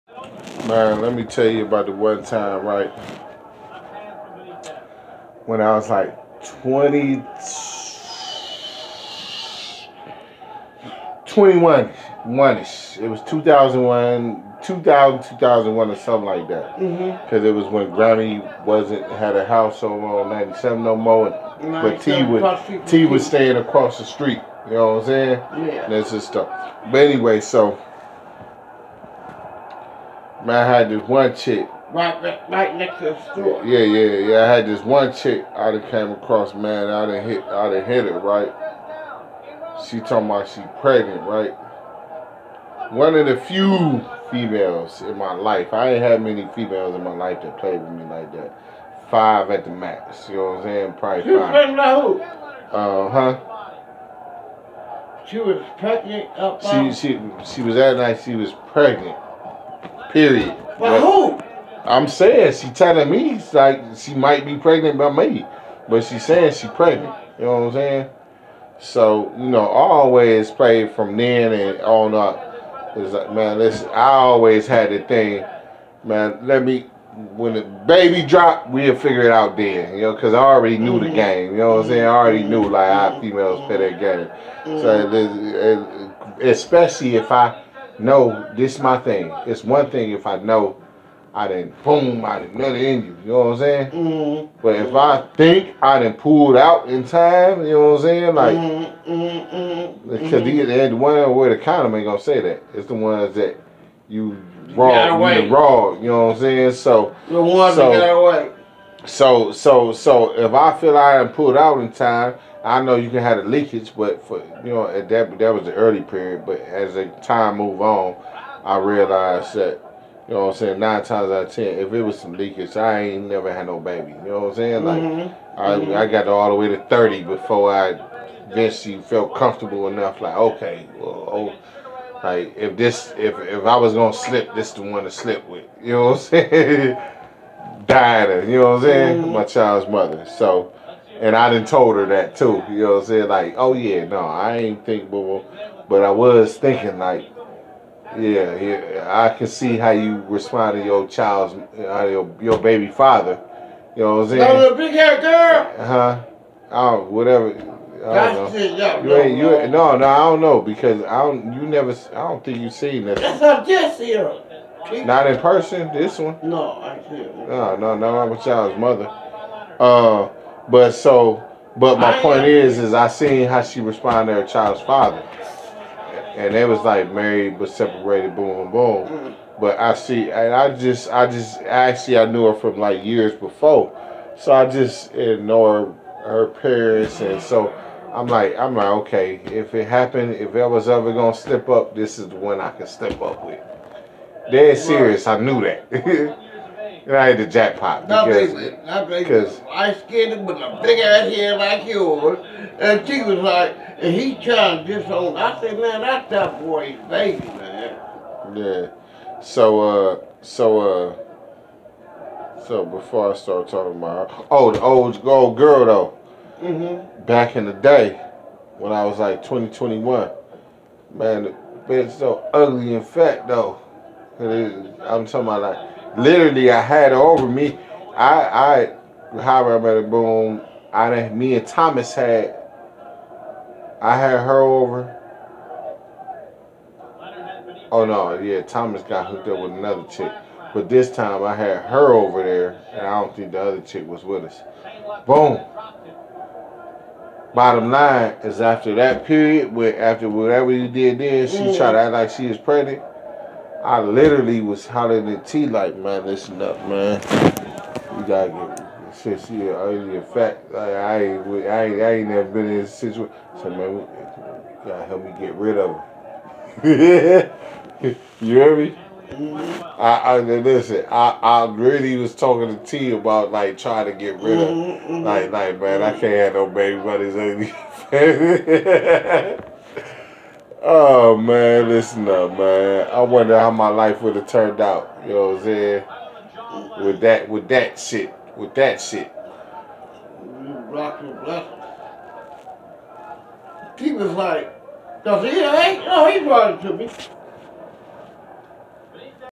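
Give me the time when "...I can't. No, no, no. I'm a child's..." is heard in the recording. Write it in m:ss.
2:46.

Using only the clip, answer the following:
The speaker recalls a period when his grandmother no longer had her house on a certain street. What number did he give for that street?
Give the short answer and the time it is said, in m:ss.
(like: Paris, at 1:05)
97, at 0:20.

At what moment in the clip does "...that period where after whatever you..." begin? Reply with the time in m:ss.
4:08.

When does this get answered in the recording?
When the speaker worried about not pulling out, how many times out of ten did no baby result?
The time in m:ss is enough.
2:00.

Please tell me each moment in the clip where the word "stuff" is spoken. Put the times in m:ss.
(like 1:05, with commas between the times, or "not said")
0:26.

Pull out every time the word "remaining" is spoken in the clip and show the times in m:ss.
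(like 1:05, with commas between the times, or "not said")
not said.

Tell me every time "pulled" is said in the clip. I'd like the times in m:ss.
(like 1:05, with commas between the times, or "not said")
1:36, 1:51.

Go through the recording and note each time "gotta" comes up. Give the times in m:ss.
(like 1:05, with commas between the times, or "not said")
4:18, 4:24.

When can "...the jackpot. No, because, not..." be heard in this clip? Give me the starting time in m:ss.
3:17.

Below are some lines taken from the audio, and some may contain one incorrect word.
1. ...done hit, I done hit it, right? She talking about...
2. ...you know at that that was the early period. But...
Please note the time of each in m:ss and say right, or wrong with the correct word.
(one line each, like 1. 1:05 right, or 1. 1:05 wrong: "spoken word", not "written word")
1. 0:37 right
2. 1:54 right.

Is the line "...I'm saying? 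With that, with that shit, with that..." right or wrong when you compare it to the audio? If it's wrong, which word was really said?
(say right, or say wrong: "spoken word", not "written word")
right.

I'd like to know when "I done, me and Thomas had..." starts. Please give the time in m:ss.
3:50.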